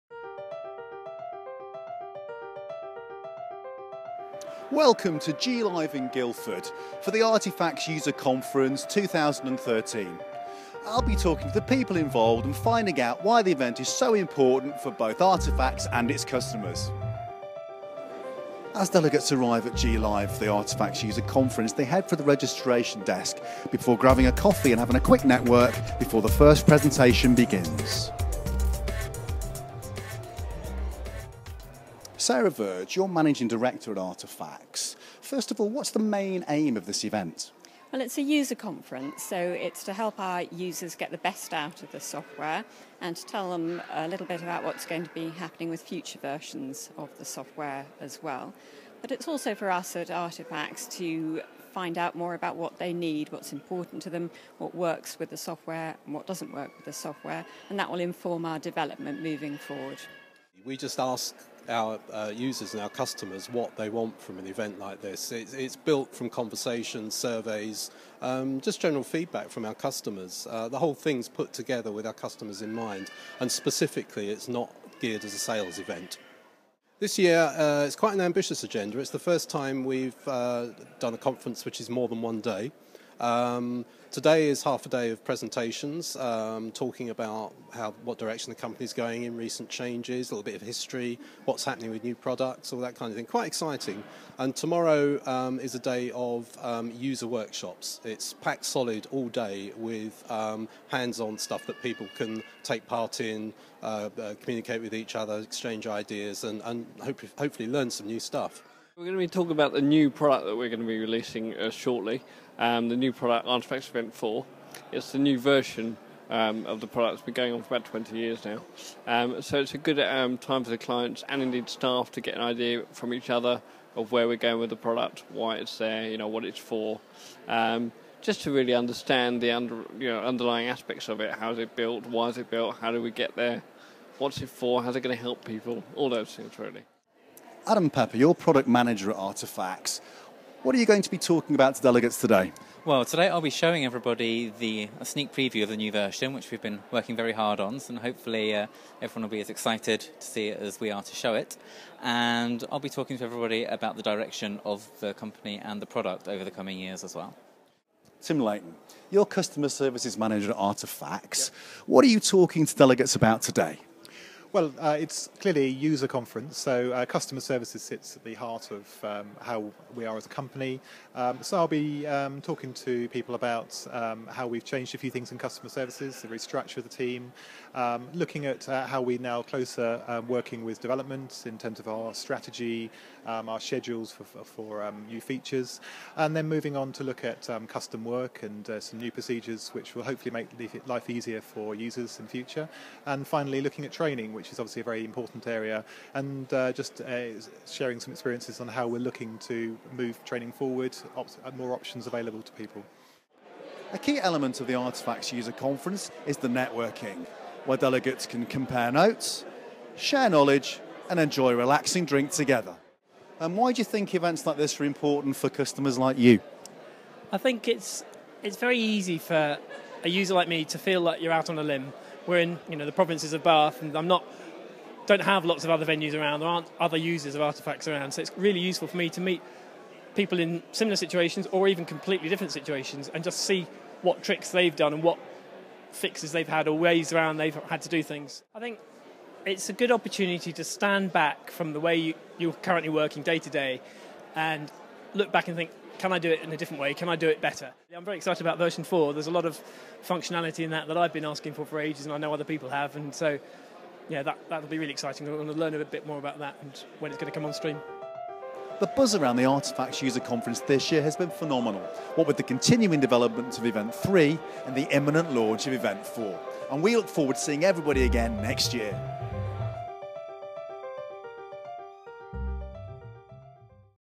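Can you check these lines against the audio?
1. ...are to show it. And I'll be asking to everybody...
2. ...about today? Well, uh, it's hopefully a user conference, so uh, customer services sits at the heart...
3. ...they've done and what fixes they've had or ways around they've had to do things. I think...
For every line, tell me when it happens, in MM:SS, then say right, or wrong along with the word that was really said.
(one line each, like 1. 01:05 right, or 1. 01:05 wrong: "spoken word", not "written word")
1. 02:30 wrong: "talking", not "asking"
2. 02:43 wrong: "clearly", not "hopefully"
3. 03:54 right.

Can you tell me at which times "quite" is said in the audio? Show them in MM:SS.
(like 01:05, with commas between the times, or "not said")
01:17, 01:33.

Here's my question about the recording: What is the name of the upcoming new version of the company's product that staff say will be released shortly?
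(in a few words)
Artifax Event 4.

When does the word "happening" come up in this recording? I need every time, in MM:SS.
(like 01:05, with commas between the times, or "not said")
00:45, 01:31.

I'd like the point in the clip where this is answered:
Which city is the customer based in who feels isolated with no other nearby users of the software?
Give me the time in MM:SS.
03:43.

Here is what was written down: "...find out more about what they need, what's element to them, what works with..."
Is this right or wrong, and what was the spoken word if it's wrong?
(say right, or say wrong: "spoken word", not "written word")
wrong: "important", not "element".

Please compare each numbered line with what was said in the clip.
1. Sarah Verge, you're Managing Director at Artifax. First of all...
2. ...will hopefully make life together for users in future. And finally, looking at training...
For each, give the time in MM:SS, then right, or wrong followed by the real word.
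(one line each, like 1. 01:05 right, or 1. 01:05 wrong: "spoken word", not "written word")
1. 00:32 right
2. 03:09 wrong: "easier", not "together".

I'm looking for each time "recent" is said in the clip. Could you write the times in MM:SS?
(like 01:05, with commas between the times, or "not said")
01:29.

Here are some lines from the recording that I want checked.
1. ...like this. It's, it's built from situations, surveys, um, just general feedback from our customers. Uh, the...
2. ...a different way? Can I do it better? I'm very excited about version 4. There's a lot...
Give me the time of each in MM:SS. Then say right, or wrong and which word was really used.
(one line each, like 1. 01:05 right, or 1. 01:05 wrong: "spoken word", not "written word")
1. 01:04 wrong: "conversations", not "situations"
2. 04:06 right.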